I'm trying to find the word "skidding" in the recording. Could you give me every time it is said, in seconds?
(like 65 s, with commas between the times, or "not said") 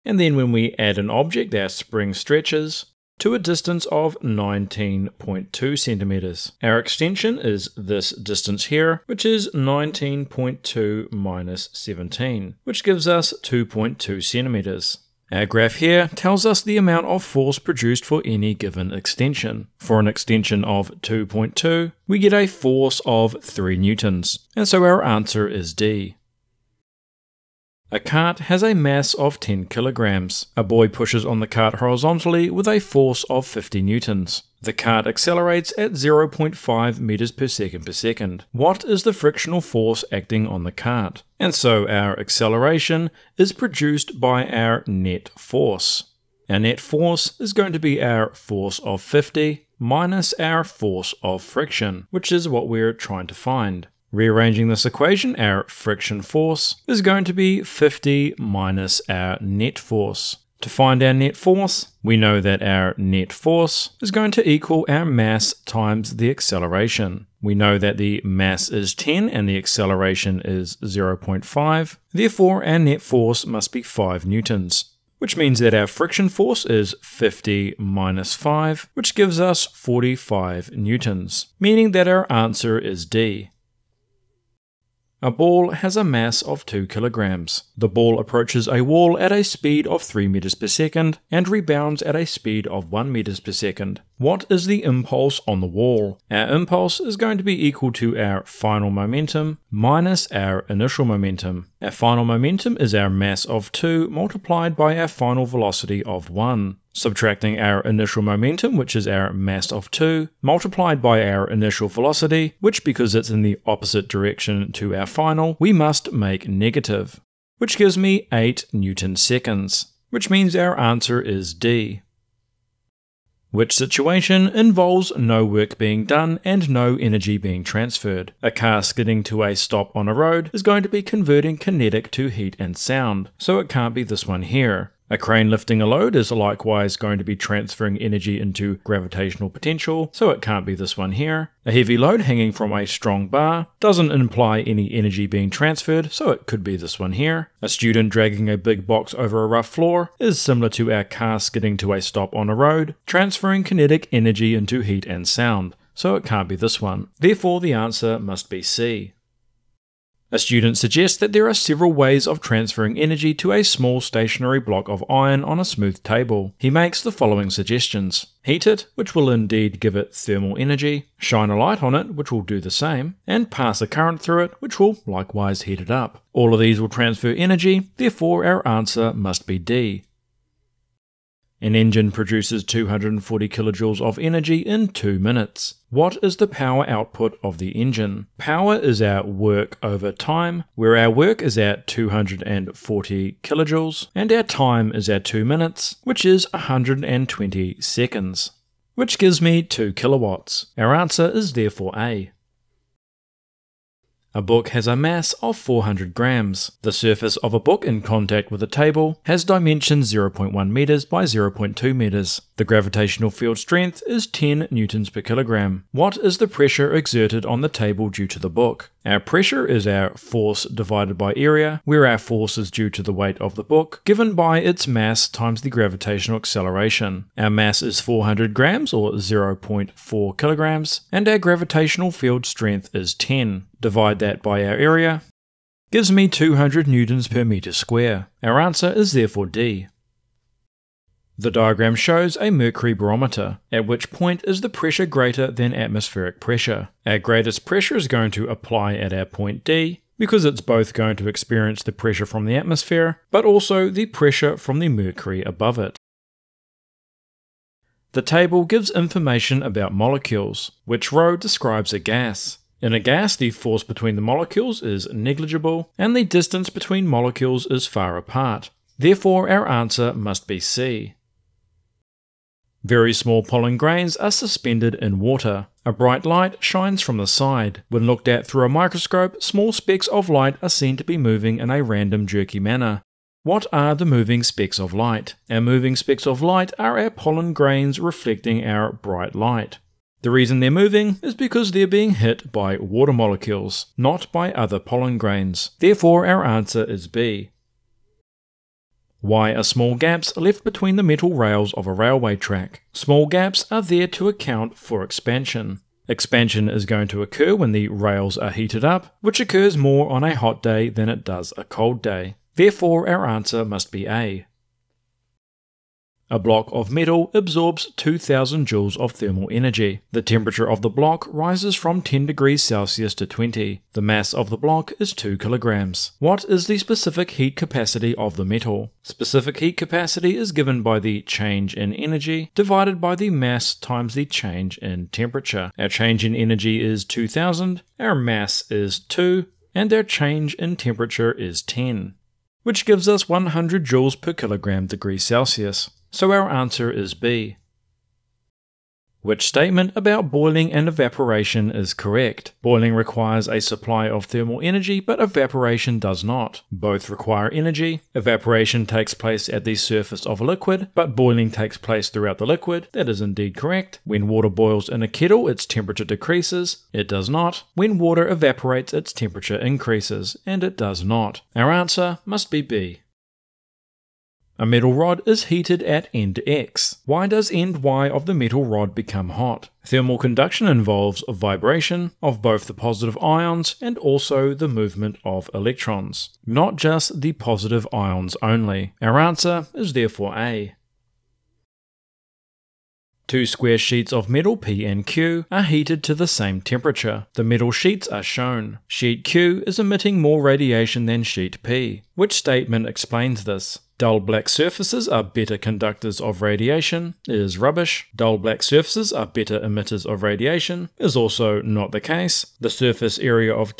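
128 s, 151 s.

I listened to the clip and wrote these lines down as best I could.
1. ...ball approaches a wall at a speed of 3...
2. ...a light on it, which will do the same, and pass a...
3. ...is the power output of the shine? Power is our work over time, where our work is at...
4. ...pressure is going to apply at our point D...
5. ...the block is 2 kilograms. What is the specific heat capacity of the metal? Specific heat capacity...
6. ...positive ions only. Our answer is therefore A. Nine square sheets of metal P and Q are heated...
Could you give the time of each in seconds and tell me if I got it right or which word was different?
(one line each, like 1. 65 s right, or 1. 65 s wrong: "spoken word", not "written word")
1. 87 s right
2. 171 s right
3. 186 s wrong: "engine", not "shine"
4. 247 s right
5. 324 s right
6. 387 s wrong: "Two", not "Nine".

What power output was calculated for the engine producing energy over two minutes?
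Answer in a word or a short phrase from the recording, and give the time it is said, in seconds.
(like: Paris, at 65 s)
2 kilowatts, at 199 s.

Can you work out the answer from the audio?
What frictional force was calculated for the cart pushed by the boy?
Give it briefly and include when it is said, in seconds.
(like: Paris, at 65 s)
45 newtons, at 79 s.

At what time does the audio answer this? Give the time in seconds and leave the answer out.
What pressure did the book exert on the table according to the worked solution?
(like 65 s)
236 s.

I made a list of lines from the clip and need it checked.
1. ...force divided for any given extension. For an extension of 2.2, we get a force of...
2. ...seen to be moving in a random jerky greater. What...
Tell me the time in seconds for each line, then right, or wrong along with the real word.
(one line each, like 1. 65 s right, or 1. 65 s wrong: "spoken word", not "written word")
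1. 17 s wrong: "produced", not "divided"
2. 280 s wrong: "manner", not "greater".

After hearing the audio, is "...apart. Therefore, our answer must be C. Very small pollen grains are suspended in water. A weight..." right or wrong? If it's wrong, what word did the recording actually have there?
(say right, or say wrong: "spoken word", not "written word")
wrong: "bright", not "weight".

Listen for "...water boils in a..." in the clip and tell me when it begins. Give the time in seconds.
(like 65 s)
364 s.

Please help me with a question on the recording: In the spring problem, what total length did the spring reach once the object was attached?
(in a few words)
19.2 centimeters.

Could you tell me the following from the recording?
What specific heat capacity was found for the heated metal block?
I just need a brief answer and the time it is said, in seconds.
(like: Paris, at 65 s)
100 joules per kilogram degree Celsius, at 343 s.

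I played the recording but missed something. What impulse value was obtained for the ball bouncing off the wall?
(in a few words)
8 newton seconds.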